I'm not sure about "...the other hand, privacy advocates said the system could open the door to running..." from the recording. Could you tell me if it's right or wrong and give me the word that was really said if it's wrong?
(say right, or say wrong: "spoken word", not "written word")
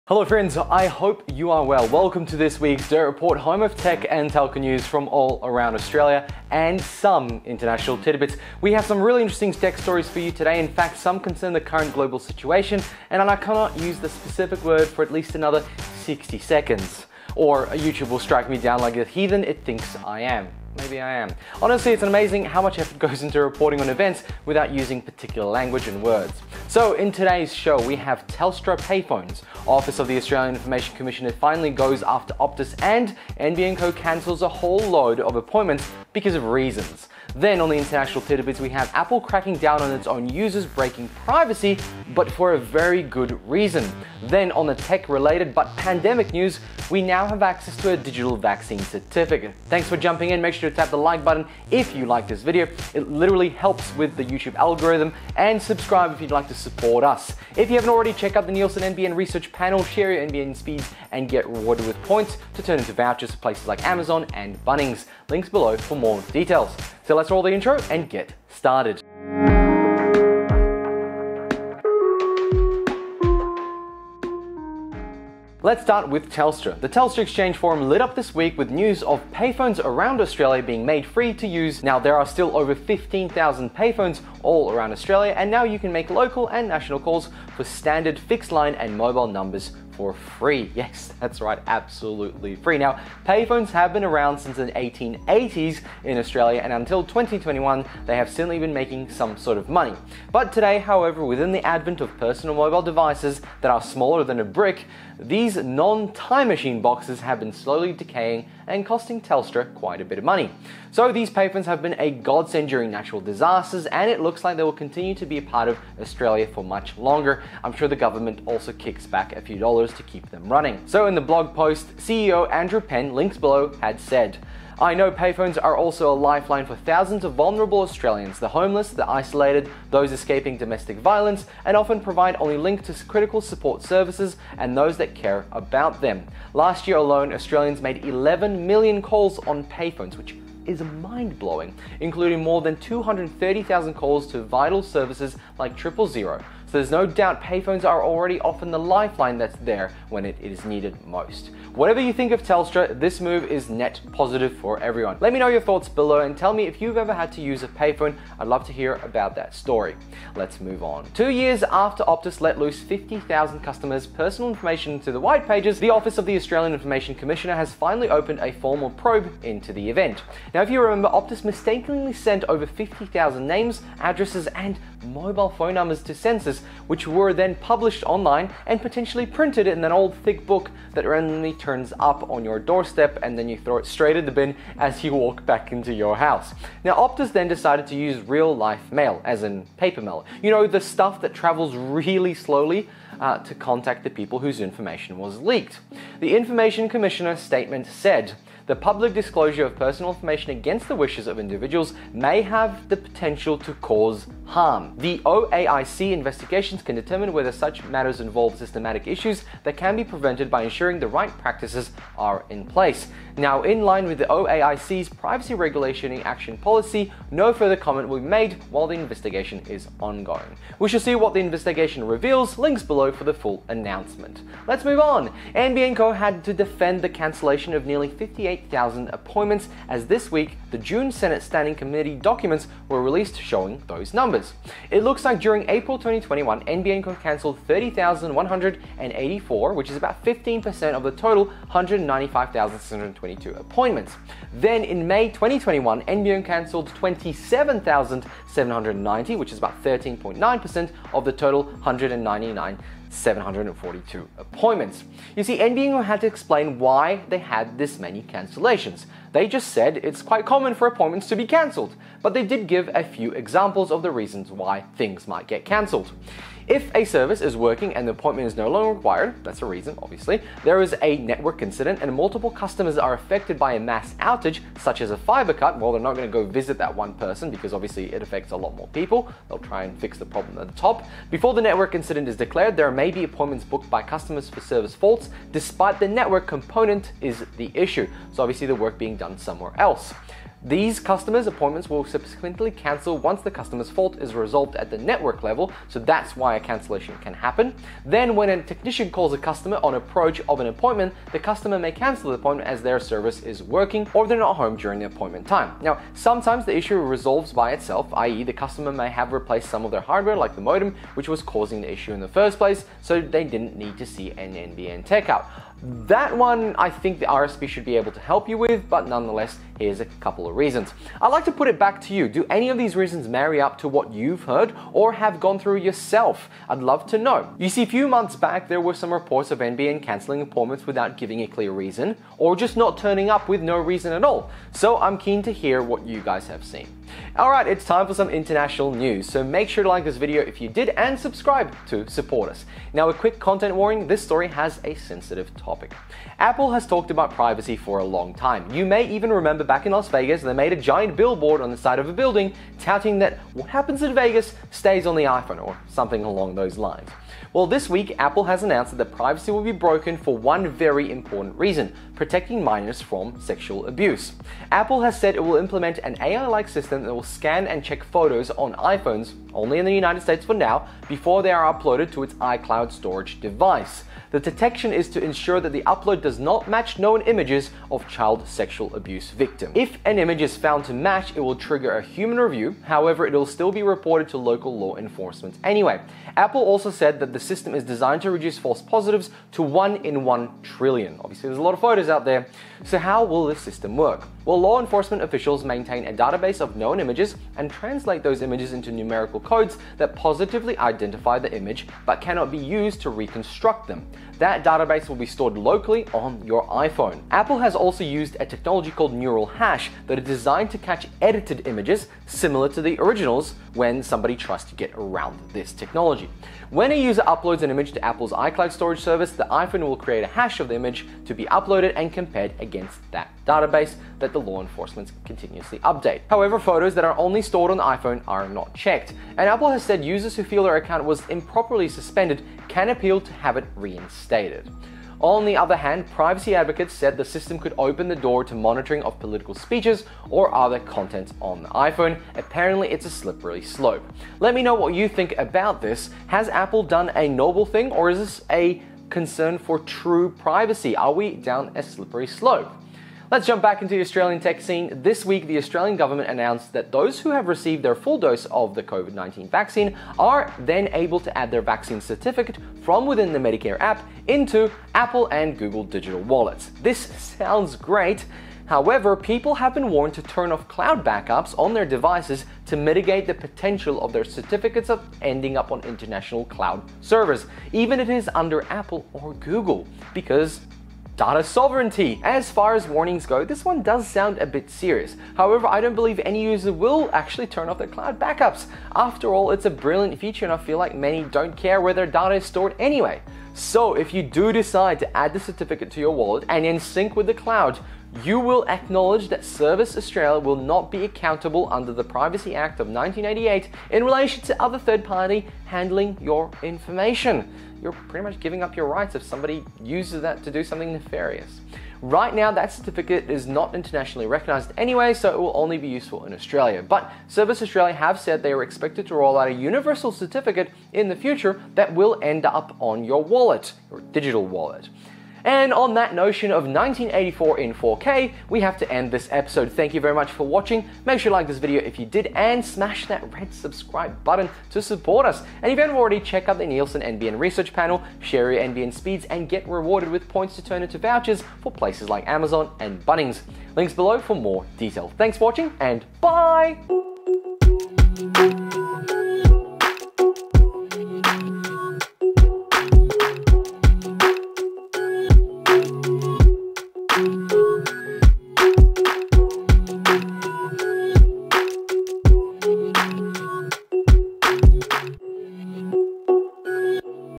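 wrong: "monitoring", not "running".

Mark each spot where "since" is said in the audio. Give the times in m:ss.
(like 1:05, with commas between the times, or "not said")
1:34.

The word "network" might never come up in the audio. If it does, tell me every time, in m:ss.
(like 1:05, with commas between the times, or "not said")
4:31, 4:41, 4:46, 4:54.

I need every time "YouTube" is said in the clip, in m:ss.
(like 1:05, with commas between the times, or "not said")
0:17, 0:54.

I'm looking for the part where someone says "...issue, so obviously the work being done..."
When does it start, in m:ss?
4:47.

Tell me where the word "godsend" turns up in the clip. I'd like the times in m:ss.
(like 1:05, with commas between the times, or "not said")
1:52.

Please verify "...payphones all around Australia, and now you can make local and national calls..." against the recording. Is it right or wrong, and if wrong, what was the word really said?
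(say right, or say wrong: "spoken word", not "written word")
right.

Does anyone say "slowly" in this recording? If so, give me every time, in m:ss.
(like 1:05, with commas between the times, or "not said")
1:47, 3:12.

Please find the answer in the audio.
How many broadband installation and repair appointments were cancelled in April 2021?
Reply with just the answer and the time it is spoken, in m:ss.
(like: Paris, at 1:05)
30,184, at 3:57.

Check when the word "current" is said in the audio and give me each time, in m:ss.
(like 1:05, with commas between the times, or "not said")
0:11.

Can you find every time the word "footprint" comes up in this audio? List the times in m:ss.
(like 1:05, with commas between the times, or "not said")
not said.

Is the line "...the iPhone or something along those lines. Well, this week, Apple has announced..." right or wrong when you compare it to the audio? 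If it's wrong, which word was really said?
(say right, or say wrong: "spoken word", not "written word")
right.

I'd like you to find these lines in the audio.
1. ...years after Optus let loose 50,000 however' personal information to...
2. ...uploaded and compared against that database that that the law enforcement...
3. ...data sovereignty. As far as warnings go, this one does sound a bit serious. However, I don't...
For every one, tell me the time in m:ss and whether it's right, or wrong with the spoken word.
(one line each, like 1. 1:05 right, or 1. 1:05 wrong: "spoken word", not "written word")
1. 2:41 wrong: "customers", not "however"
2. 7:01 right
3. 8:01 right.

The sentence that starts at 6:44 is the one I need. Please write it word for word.
That database will be stored locally on your iPhone.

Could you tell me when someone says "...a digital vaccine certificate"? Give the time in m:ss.
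0:47.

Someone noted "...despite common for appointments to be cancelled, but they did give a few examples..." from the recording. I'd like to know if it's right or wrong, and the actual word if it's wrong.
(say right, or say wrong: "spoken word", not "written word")
wrong: "quite", not "despite".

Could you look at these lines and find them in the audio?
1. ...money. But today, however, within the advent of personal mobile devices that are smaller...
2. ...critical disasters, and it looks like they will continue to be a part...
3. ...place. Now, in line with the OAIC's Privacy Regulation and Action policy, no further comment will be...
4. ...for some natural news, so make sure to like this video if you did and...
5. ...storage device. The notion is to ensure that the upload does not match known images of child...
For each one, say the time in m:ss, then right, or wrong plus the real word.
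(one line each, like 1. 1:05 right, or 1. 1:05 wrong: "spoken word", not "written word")
1. 1:39 right
2. 1:52 wrong: "natural", not "critical"
3. 3:32 right
4. 5:38 wrong: "international", not "natural"
5. 6:12 wrong: "detection", not "notion".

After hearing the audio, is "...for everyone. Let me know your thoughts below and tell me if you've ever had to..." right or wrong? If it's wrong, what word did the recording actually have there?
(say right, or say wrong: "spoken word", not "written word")
right.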